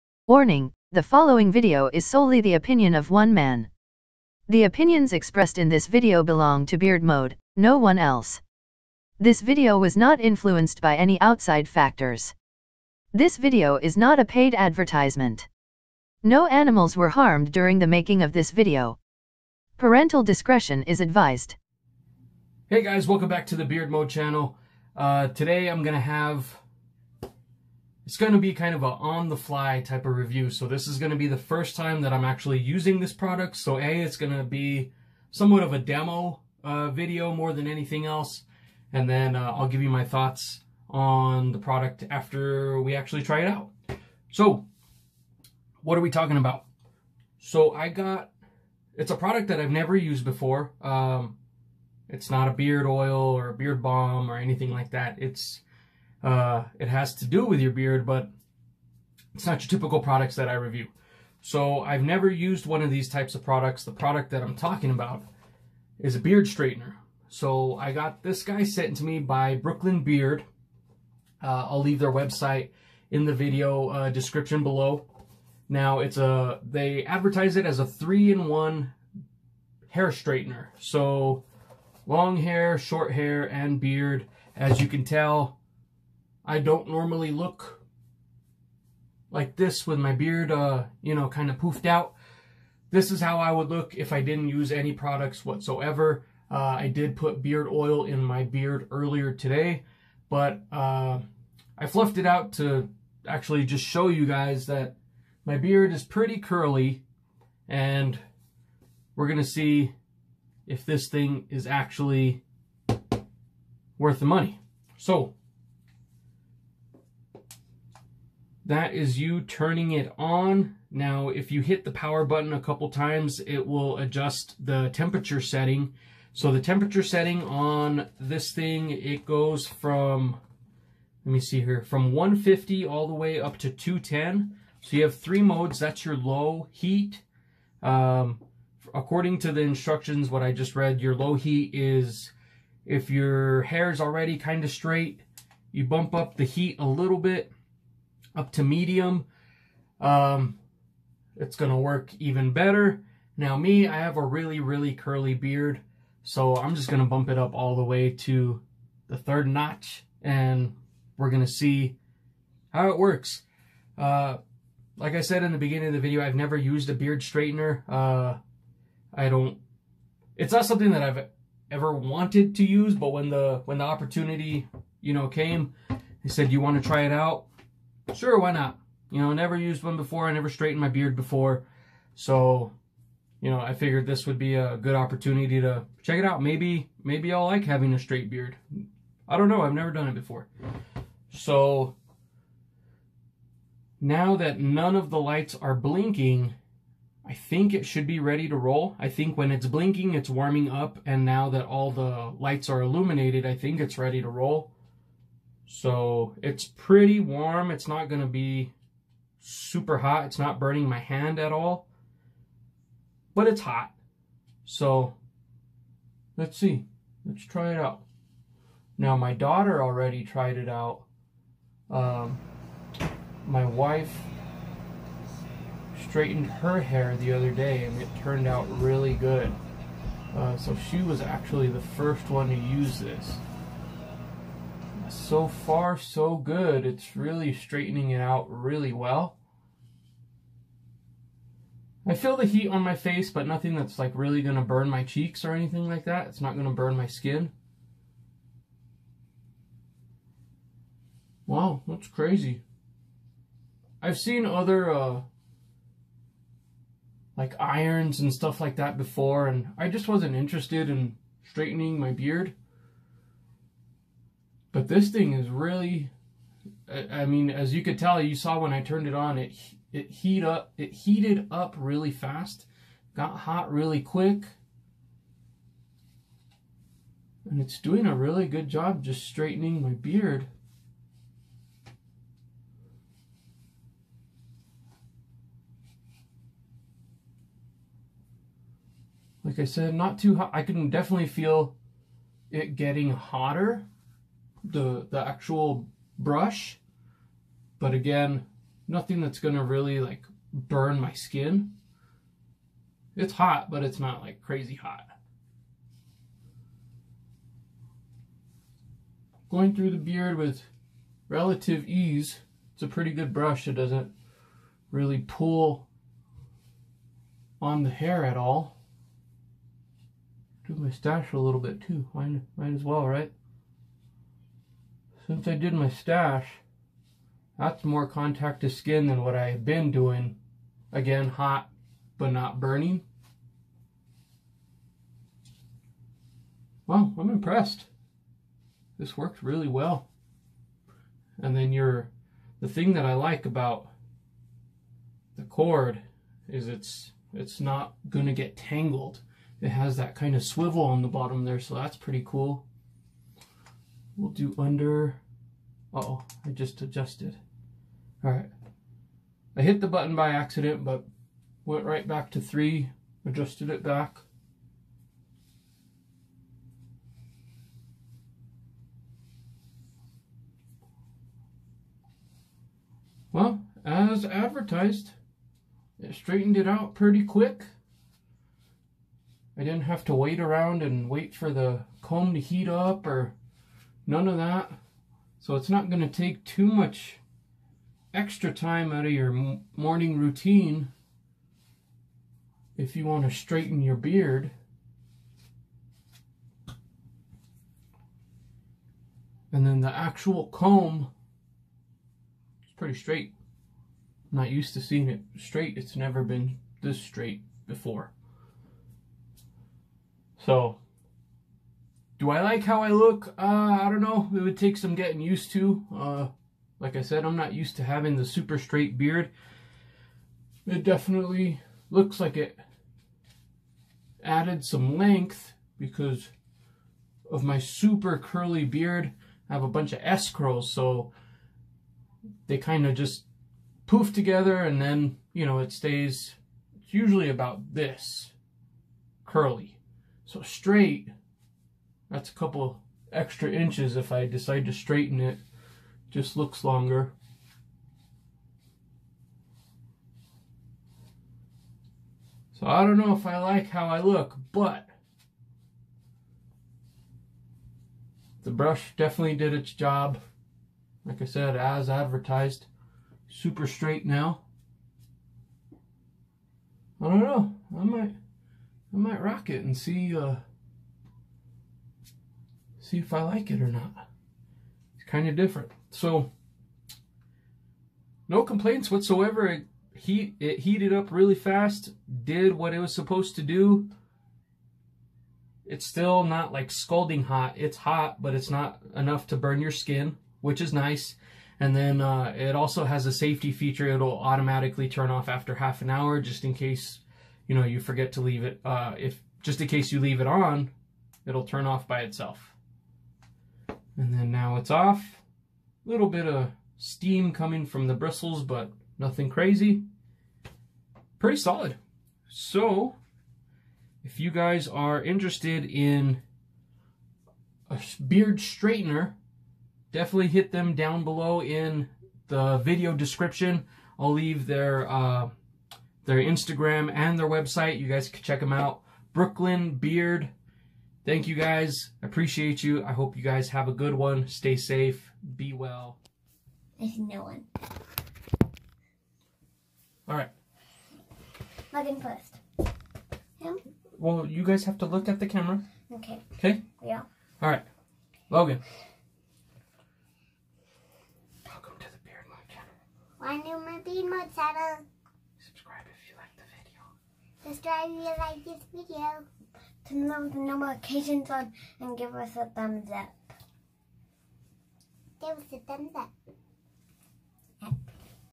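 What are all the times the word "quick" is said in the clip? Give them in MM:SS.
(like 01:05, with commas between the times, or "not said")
04:34, 06:17.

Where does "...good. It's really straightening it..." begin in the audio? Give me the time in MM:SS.
03:56.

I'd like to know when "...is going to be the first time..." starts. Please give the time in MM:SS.
00:30.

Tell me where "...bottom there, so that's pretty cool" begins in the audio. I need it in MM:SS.
05:51.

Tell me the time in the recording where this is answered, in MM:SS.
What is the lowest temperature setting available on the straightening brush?
02:12.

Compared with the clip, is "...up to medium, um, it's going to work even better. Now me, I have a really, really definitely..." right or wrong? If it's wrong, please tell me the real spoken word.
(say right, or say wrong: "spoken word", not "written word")
wrong: "curly", not "definitely".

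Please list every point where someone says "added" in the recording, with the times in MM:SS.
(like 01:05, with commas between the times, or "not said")
07:04.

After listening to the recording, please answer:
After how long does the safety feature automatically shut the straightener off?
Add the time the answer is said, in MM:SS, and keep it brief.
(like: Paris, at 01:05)
half an hour, at 08:15.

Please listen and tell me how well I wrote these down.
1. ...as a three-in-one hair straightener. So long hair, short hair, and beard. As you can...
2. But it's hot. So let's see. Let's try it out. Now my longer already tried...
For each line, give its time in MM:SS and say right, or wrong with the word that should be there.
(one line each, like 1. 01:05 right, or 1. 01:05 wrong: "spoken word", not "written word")
1. 01:17 right
2. 03:33 wrong: "daughter", not "longer".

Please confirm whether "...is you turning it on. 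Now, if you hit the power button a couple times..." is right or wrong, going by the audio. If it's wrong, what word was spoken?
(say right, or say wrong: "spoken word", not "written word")
right.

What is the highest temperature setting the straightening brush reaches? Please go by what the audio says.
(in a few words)
210.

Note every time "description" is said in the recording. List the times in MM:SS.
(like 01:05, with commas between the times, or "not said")
01:14, 08:42.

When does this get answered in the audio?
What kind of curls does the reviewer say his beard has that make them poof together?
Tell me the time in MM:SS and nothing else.
07:10.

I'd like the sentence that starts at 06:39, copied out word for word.
And then the actual comb is pretty straight.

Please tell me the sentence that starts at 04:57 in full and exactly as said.
But again, nothing that's going to really like burn my skin.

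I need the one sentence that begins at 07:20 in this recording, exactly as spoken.
So straight that's a couple extra inches if I decide to straighten it.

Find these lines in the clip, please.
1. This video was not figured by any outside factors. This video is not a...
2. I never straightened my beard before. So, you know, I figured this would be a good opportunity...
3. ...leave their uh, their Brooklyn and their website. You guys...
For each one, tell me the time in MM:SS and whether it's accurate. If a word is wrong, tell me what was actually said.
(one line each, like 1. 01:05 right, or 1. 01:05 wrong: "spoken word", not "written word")
1. 00:09 wrong: "influenced", not "figured"
2. 03:00 right
3. 08:44 wrong: "Instagram", not "Brooklyn".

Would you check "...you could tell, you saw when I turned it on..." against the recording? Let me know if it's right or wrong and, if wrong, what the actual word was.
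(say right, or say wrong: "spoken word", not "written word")
right.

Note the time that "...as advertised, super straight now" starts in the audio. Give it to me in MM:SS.
07:41.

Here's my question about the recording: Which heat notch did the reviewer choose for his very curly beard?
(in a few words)
third notch.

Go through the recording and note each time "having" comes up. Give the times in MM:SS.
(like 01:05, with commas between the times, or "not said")
03:07, 06:57.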